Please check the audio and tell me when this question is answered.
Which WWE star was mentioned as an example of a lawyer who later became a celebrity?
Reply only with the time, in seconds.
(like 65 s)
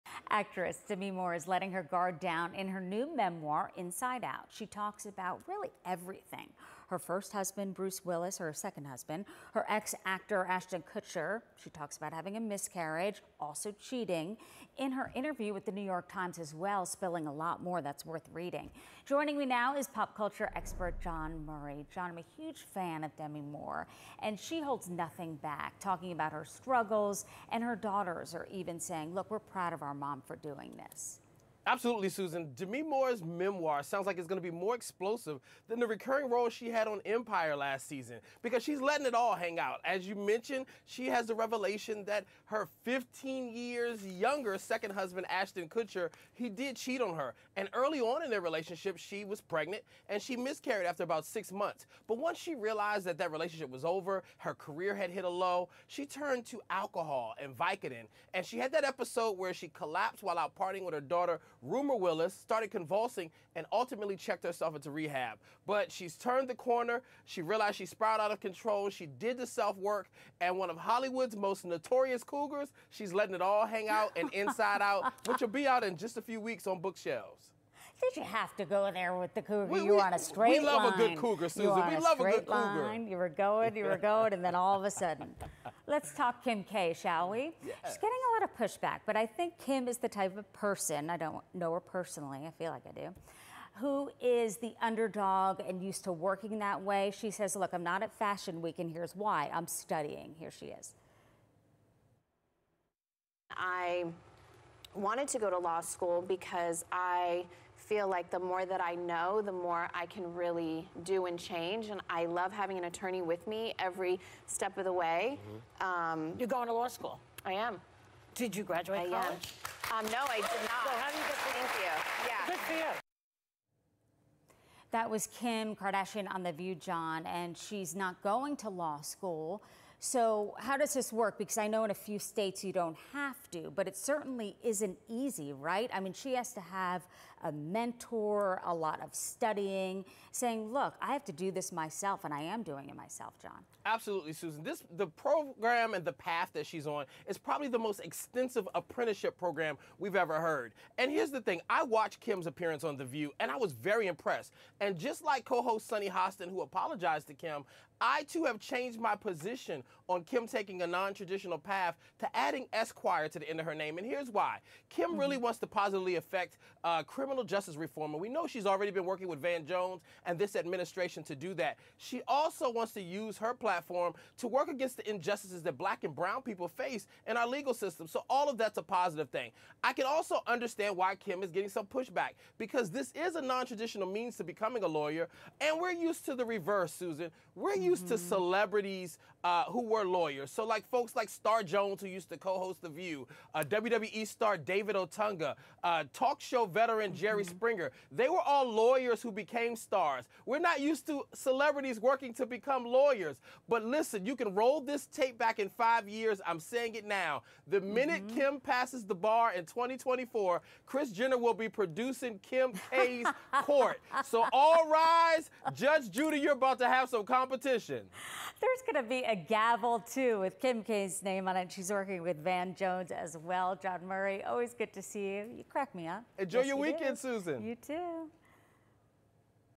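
194 s.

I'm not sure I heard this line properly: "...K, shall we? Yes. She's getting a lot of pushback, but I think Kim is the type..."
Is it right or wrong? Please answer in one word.
right.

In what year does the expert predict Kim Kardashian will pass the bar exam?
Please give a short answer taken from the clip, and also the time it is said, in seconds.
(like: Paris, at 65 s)
2024, at 209 s.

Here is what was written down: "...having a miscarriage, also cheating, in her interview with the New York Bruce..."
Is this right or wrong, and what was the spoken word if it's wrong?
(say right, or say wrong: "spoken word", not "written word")
wrong: "Times", not "Bruce".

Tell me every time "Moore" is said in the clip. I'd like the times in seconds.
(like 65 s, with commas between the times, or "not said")
1 s, 23 s, 32 s.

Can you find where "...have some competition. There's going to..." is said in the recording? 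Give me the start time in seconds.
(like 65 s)
216 s.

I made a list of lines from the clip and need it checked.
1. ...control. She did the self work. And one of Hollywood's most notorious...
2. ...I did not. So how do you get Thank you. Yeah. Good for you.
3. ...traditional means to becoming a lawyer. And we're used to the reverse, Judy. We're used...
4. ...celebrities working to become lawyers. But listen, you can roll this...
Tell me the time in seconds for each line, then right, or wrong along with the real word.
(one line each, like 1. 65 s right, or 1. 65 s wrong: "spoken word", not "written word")
1. 68 s right
2. 120 s right
3. 183 s wrong: "Susan", not "Judy"
4. 201 s right.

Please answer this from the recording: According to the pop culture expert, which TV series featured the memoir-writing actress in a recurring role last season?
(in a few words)
Empire.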